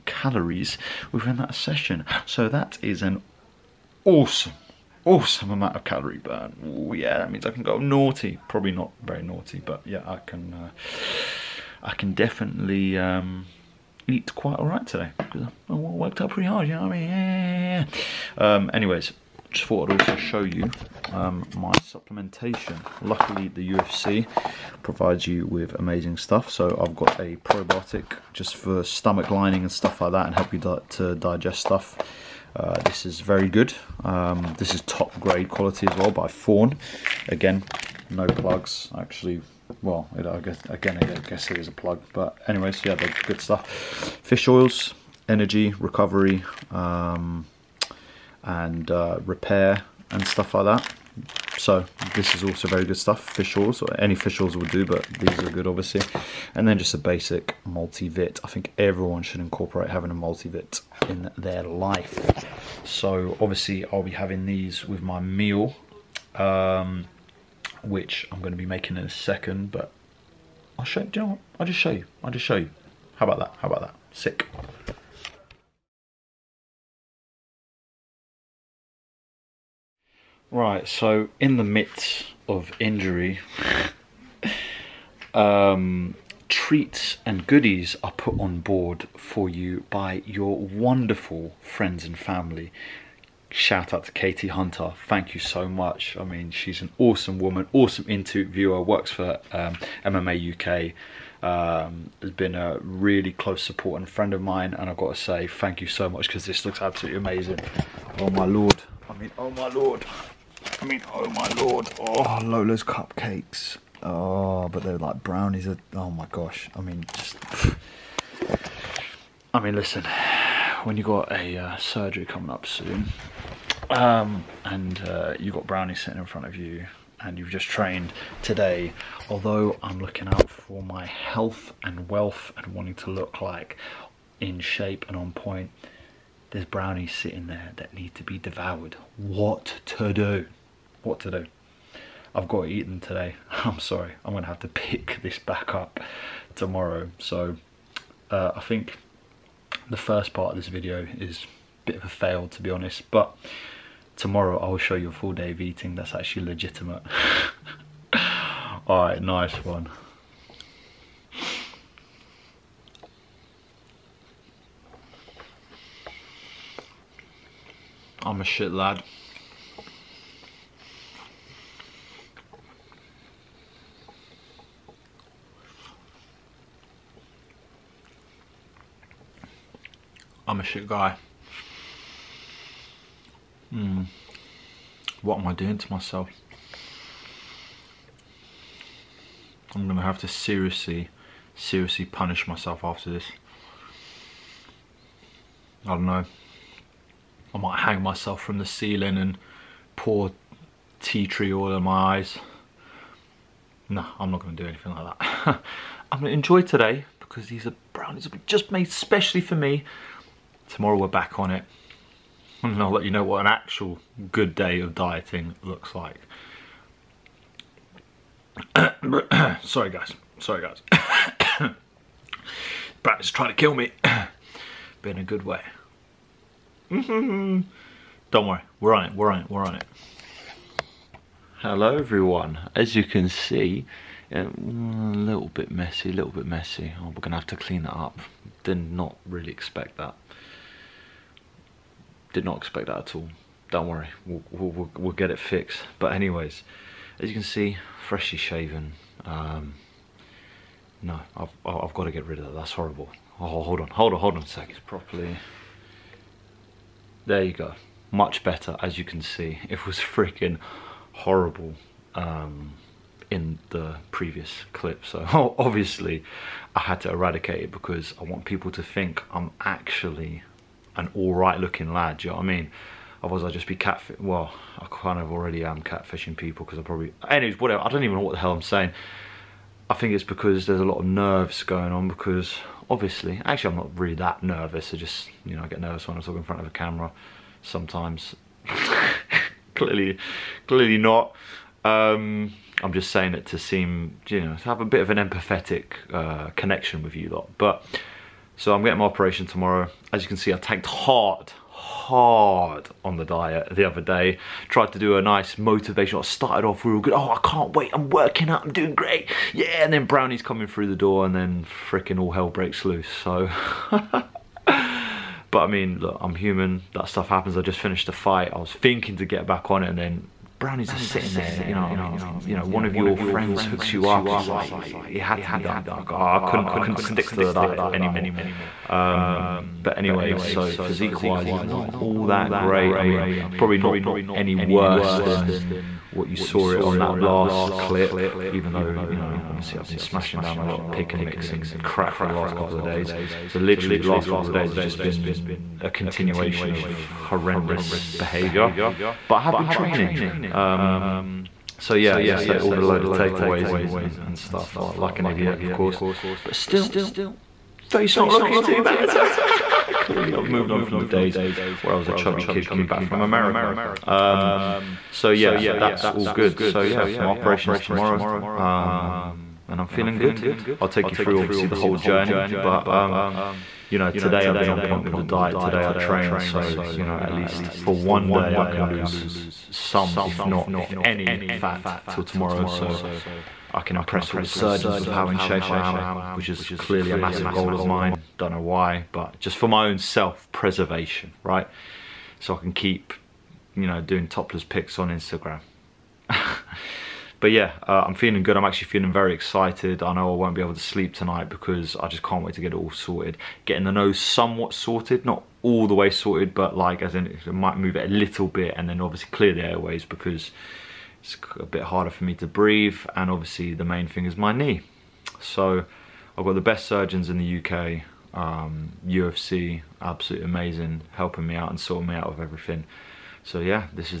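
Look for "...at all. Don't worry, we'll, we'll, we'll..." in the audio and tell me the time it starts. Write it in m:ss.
4:02.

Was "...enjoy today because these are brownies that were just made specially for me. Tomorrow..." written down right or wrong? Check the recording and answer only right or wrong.
right.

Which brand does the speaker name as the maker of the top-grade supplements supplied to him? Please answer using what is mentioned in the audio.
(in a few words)
Fawn.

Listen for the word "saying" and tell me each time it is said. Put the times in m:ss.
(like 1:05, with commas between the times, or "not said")
4:38, 4:53.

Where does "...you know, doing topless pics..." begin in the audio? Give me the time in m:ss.
6:33.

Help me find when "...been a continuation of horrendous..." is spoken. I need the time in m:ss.
5:44.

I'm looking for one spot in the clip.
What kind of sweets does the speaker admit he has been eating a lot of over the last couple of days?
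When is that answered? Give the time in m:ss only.
5:40.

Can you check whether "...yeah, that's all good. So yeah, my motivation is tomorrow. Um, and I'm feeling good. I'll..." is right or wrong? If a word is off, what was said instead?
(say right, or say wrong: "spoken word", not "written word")
wrong: "operation", not "motivation".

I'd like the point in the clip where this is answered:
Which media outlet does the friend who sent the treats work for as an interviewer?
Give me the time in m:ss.
1:40.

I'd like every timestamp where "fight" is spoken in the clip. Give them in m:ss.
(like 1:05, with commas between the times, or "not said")
5:18.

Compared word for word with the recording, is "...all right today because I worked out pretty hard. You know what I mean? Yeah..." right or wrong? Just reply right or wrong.
right.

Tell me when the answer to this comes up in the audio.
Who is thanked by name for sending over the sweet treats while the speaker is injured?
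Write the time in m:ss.
1:34.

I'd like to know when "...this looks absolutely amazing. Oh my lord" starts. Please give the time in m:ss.
1:46.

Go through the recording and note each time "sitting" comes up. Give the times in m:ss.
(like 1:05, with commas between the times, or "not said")
2:06, 2:17, 5:20.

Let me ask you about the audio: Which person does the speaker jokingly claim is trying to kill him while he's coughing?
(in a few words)
Brad.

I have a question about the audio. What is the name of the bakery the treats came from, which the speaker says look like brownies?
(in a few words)
Lola's cupcakes.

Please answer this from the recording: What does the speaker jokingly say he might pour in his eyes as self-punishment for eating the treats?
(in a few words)
tea tree oil.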